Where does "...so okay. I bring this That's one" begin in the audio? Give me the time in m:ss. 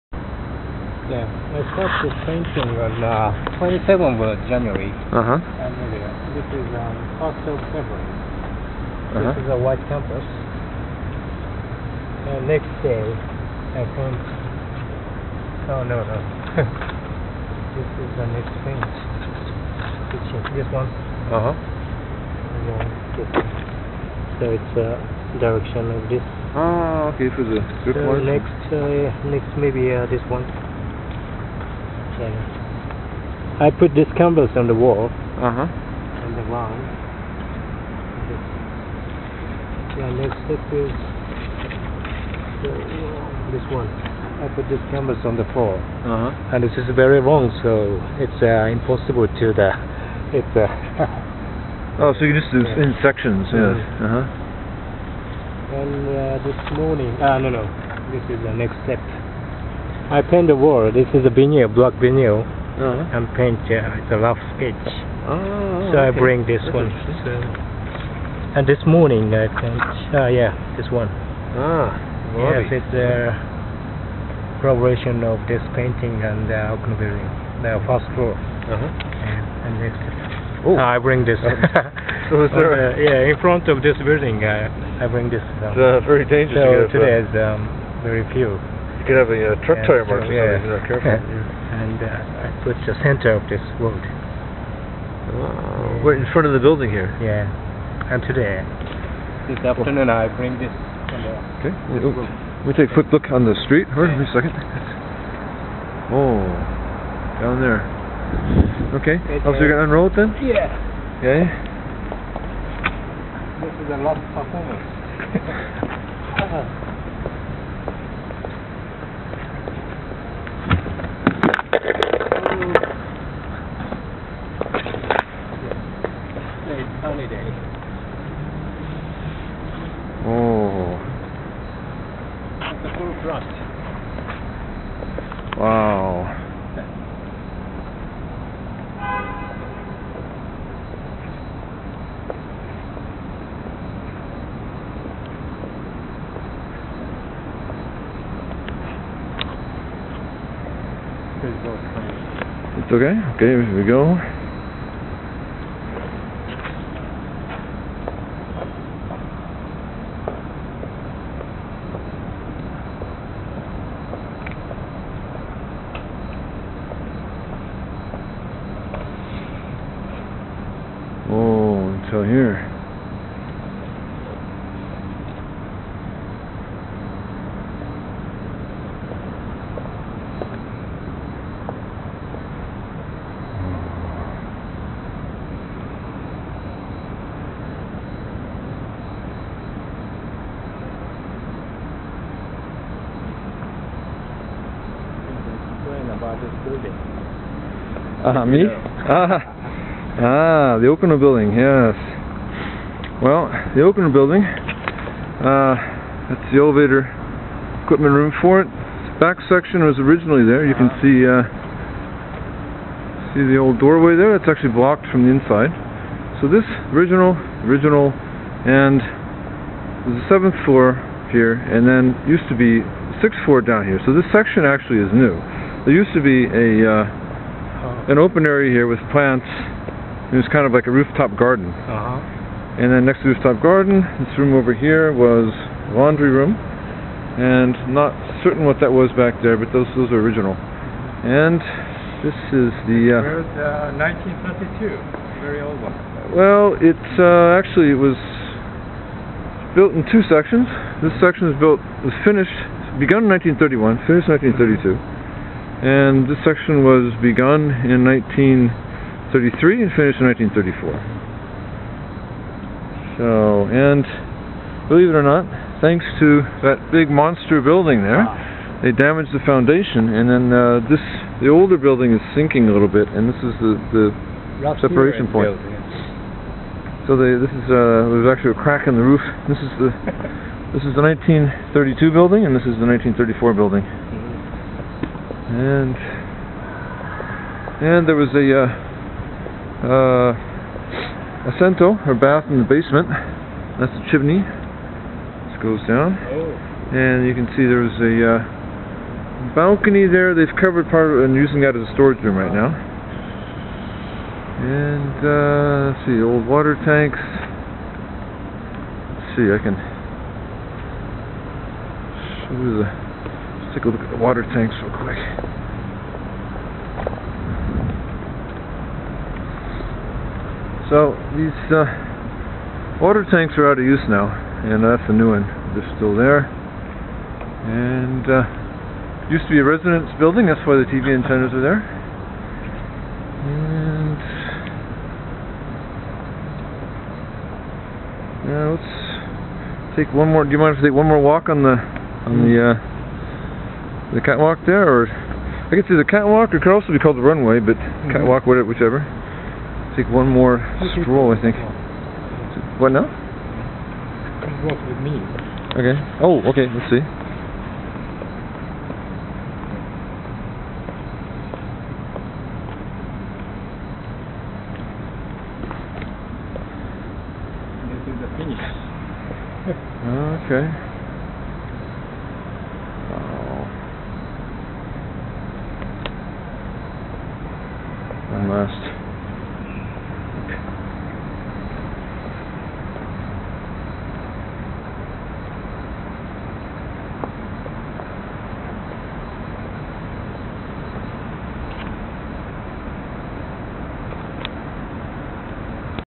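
1:05.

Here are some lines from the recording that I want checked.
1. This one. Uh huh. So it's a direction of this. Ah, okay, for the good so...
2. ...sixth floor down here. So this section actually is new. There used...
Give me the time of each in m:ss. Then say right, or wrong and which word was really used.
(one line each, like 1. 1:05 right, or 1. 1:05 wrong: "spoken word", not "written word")
1. 0:20 right
2. 3:43 right.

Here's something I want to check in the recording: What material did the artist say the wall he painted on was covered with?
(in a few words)
black vinyl.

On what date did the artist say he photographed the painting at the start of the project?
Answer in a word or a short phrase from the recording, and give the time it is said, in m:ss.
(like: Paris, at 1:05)
27th of January, at 0:03.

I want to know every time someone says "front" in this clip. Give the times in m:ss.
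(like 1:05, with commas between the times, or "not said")
1:23, 1:36.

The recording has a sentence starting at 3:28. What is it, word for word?
This back section was originally there.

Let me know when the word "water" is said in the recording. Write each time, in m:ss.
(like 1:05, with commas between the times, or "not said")
5:06, 5:14, 5:22.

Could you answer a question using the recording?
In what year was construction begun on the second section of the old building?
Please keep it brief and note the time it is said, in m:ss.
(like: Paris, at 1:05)
1933, at 4:18.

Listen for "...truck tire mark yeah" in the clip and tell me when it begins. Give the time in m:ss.
1:29.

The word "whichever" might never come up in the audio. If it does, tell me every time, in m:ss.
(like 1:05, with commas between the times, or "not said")
5:48.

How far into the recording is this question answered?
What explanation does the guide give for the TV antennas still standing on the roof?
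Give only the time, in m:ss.
5:29.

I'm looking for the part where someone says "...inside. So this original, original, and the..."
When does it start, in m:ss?
3:35.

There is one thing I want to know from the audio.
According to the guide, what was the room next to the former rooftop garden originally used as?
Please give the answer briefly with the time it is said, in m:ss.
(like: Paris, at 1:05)
laundry room, at 3:55.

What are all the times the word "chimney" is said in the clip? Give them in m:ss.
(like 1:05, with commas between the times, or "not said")
4:54.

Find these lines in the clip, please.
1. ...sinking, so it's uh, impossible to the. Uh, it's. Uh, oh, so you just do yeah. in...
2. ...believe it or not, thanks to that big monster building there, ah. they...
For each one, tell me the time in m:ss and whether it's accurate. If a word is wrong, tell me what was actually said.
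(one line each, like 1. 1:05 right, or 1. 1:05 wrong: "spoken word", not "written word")
1. 0:47 wrong: "wrong", not "sinking"
2. 4:24 right.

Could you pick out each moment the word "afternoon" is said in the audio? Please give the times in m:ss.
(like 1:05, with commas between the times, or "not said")
1:39.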